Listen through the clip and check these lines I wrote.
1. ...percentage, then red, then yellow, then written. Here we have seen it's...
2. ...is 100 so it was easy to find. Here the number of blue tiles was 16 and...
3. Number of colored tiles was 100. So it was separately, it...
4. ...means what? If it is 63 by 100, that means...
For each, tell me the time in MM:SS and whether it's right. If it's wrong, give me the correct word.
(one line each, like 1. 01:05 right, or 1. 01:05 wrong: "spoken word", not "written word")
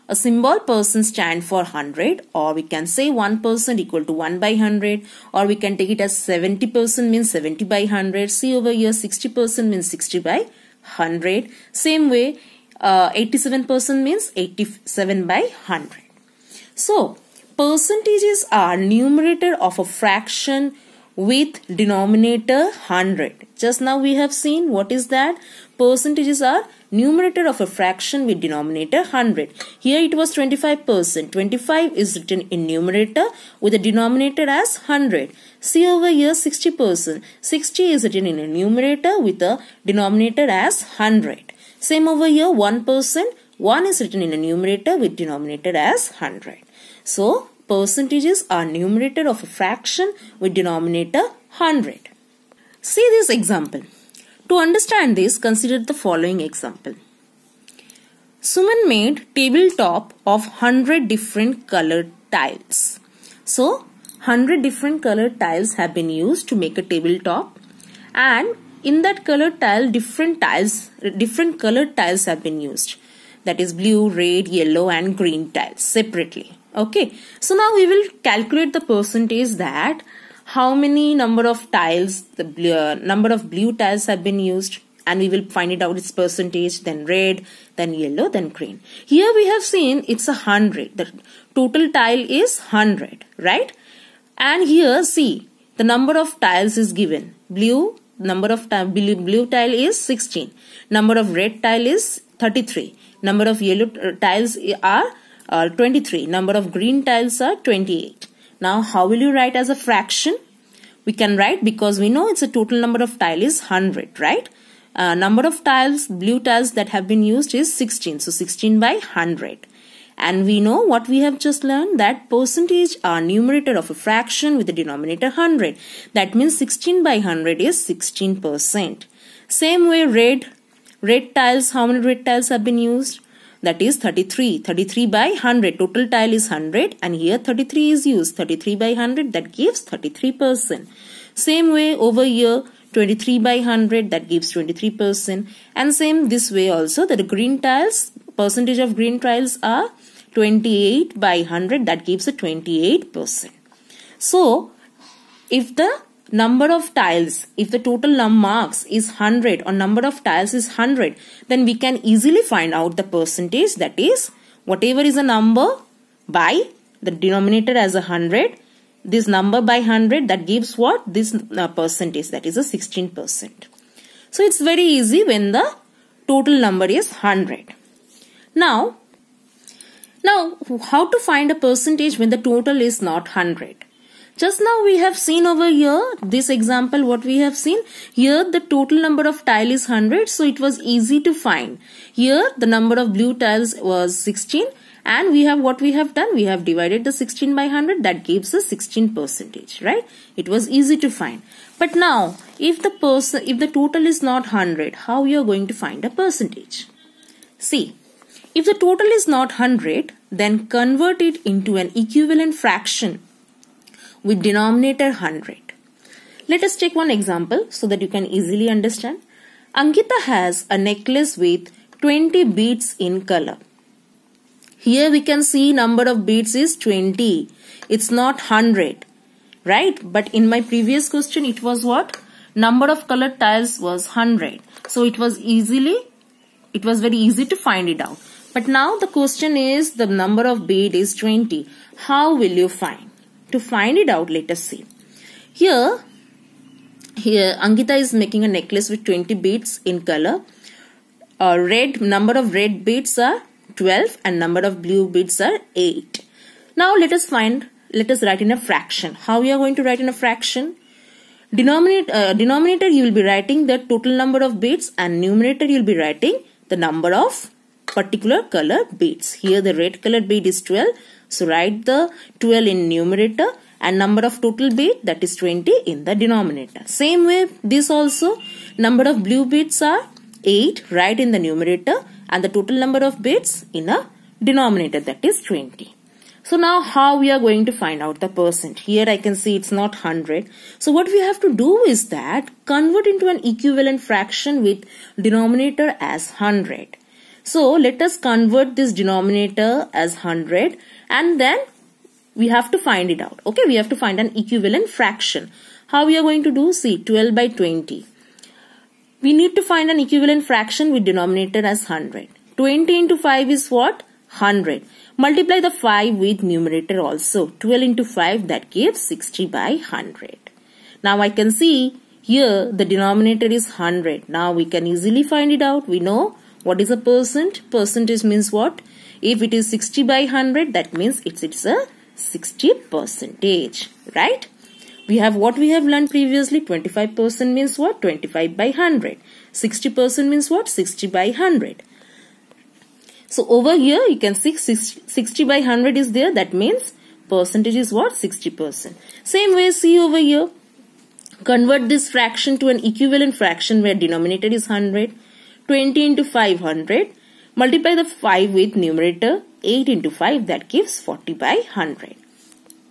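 1. 01:26 wrong: "green", not "written"
2. 03:09 right
3. 03:52 wrong: "easily", not "separately"
4. 05:28 wrong: "60", not "63".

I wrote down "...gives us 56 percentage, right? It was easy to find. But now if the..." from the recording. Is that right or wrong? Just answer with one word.
wrong.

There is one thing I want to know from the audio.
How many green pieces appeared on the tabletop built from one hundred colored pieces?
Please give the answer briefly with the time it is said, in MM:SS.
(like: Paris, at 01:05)
28, at 01:46.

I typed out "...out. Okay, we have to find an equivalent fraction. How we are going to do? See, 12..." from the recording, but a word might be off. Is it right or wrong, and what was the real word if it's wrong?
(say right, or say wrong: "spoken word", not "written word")
right.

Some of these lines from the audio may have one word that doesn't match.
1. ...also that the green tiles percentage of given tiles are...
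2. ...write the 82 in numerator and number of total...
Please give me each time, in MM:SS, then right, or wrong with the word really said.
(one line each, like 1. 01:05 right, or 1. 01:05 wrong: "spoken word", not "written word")
1. 02:26 wrong: "green", not "given"
2. 04:31 wrong: "12", not "82".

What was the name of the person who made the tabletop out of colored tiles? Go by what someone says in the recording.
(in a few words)
Suman.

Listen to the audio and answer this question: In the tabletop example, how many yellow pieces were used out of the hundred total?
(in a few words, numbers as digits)
23.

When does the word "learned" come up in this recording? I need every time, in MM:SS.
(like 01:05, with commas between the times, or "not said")
02:01, 05:35.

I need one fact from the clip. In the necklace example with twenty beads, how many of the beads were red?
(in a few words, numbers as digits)
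12.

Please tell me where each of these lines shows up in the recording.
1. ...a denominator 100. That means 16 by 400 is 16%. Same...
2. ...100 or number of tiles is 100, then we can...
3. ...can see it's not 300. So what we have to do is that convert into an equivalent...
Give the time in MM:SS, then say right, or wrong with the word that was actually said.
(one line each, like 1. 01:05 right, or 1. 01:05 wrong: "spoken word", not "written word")
1. 02:04 wrong: "100", not "400"
2. 02:39 right
3. 04:49 wrong: "100", not "300".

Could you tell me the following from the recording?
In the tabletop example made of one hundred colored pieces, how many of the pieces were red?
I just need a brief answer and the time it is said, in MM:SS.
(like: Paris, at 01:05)
33, at 01:40.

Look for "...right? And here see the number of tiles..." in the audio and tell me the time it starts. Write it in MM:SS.
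01:33.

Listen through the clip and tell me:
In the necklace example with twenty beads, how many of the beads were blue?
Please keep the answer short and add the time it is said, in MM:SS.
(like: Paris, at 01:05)
8, at 04:14.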